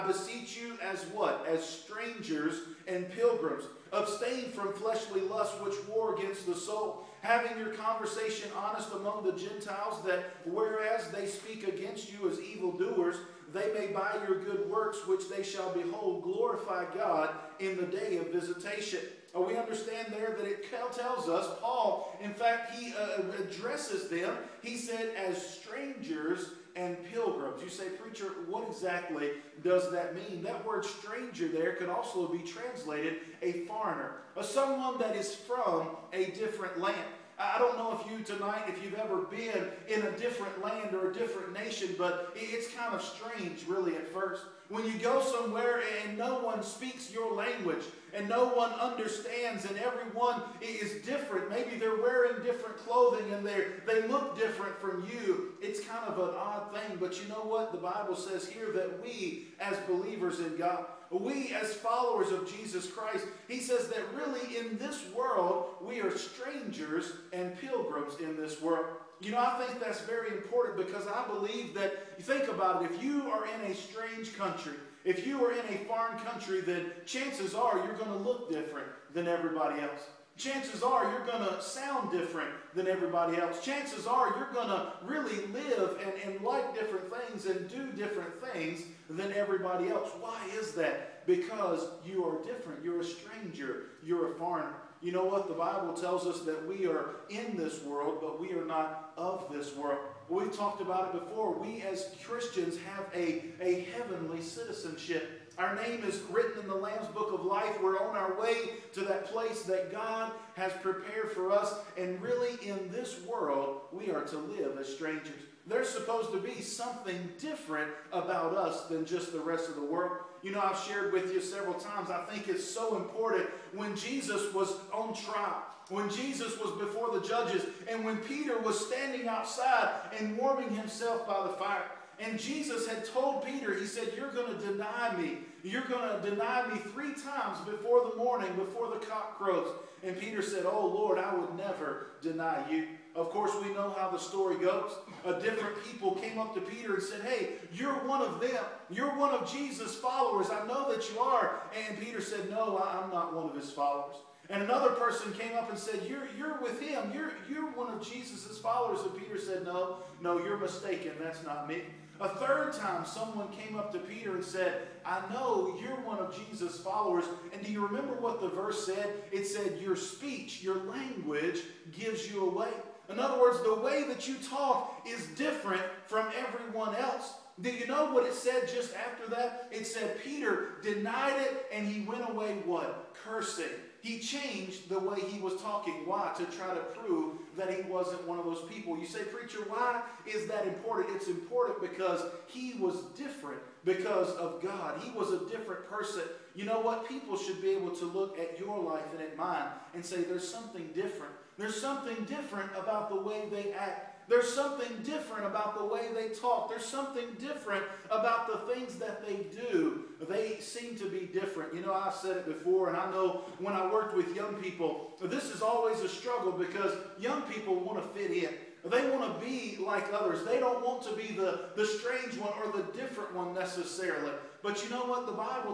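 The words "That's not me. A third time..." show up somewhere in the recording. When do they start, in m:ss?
2:41.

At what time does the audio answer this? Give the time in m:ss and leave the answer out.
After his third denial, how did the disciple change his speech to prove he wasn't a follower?
3:03.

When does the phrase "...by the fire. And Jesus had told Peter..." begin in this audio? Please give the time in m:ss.
2:11.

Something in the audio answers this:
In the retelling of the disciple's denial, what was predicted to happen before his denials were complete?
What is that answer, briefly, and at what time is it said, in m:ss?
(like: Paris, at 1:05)
the cock crows, at 2:18.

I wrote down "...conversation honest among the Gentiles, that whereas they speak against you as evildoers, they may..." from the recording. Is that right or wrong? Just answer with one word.
right.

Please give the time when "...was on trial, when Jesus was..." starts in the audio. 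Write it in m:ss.
2:04.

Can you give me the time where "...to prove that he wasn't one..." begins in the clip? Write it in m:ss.
3:06.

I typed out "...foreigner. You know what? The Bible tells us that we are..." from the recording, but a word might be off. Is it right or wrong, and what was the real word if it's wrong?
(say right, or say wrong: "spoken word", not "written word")
right.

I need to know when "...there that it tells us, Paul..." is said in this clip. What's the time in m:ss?
0:20.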